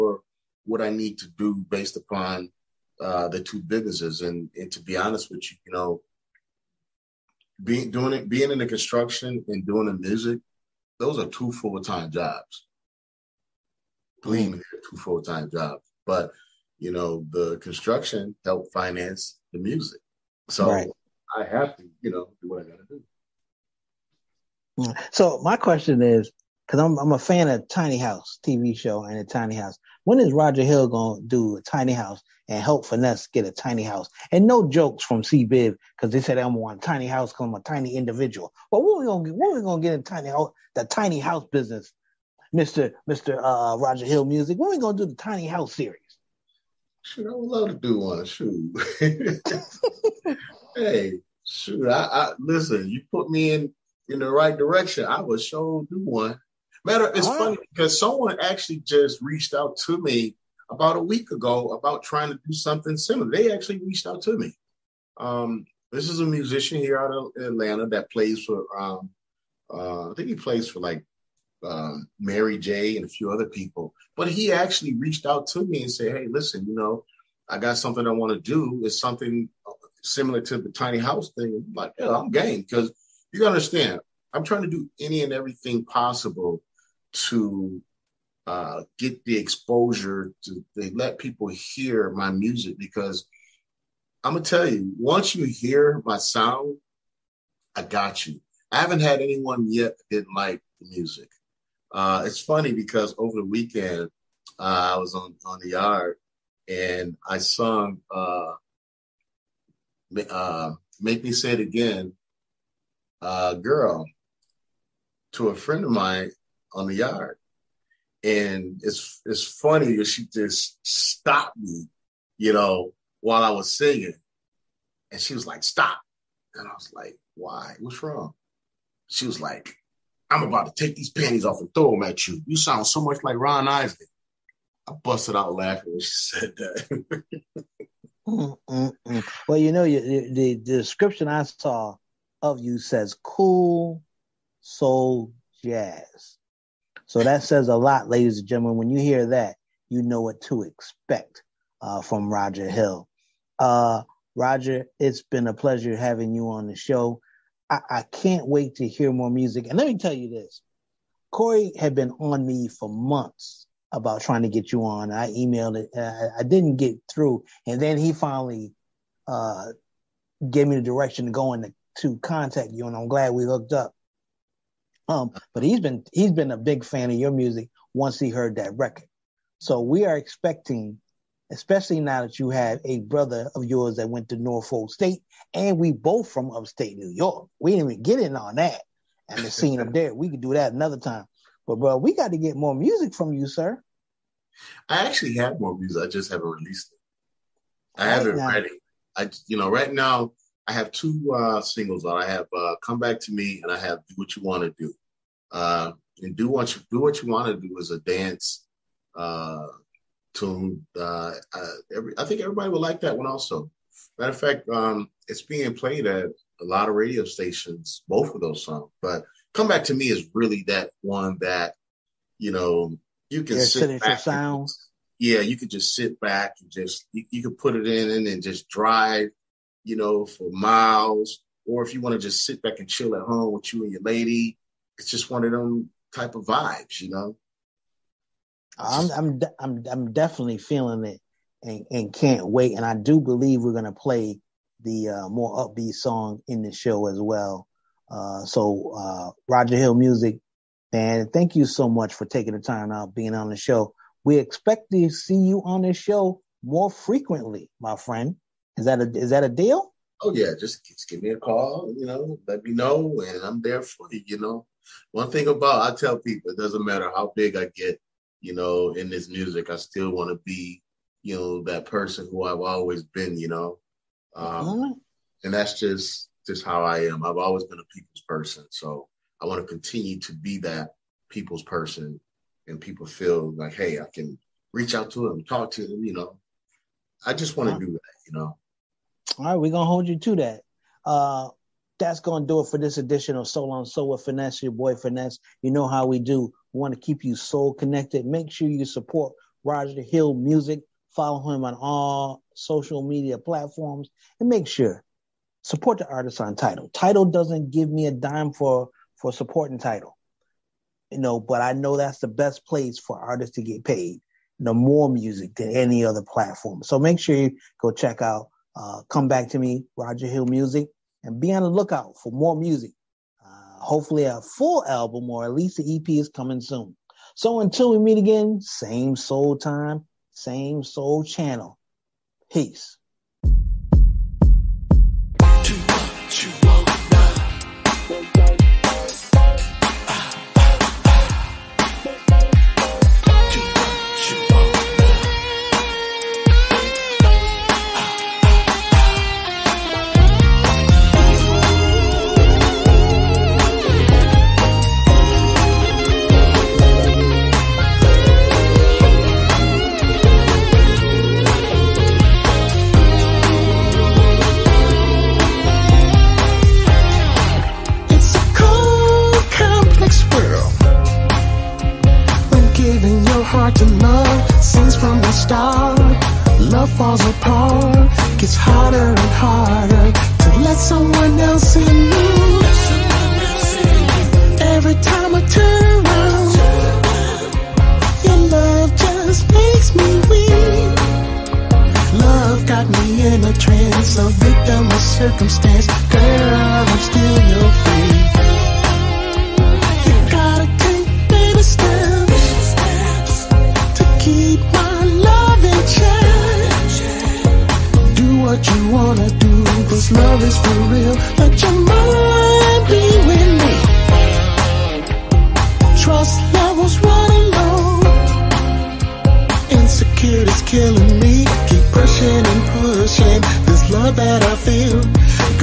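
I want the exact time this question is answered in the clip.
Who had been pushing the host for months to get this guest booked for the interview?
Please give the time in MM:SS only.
02:41.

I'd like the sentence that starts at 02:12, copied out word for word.
You sound so much like Ron Isley.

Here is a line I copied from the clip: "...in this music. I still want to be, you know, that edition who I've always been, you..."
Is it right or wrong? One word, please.
wrong.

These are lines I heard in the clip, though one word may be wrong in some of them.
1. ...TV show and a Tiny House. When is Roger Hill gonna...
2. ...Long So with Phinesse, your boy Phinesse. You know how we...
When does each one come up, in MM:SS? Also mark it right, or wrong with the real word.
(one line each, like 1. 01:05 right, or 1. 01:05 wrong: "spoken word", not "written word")
1. 00:28 right
2. 04:53 right.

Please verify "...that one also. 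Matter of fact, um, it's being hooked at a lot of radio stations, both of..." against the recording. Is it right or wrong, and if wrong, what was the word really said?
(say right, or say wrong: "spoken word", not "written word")
wrong: "played", not "hooked".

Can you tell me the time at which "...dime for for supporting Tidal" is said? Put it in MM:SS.
05:08.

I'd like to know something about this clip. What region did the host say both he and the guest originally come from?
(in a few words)
Upstate New York.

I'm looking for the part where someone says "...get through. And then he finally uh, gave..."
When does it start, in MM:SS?
02:46.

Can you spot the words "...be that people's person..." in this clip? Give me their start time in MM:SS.
04:40.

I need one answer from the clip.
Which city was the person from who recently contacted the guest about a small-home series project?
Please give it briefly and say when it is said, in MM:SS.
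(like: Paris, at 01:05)
Atlanta, at 01:07.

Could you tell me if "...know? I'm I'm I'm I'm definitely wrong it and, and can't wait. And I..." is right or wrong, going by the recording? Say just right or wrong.
wrong.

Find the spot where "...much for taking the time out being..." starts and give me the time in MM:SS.
04:11.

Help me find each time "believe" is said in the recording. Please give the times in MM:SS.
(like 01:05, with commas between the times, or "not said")
00:14, 04:03.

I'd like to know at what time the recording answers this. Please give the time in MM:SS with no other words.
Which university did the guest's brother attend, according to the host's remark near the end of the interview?
03:04.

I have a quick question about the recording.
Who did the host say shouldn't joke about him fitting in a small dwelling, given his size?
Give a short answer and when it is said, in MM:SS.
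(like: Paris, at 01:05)
C Biv, at 00:35.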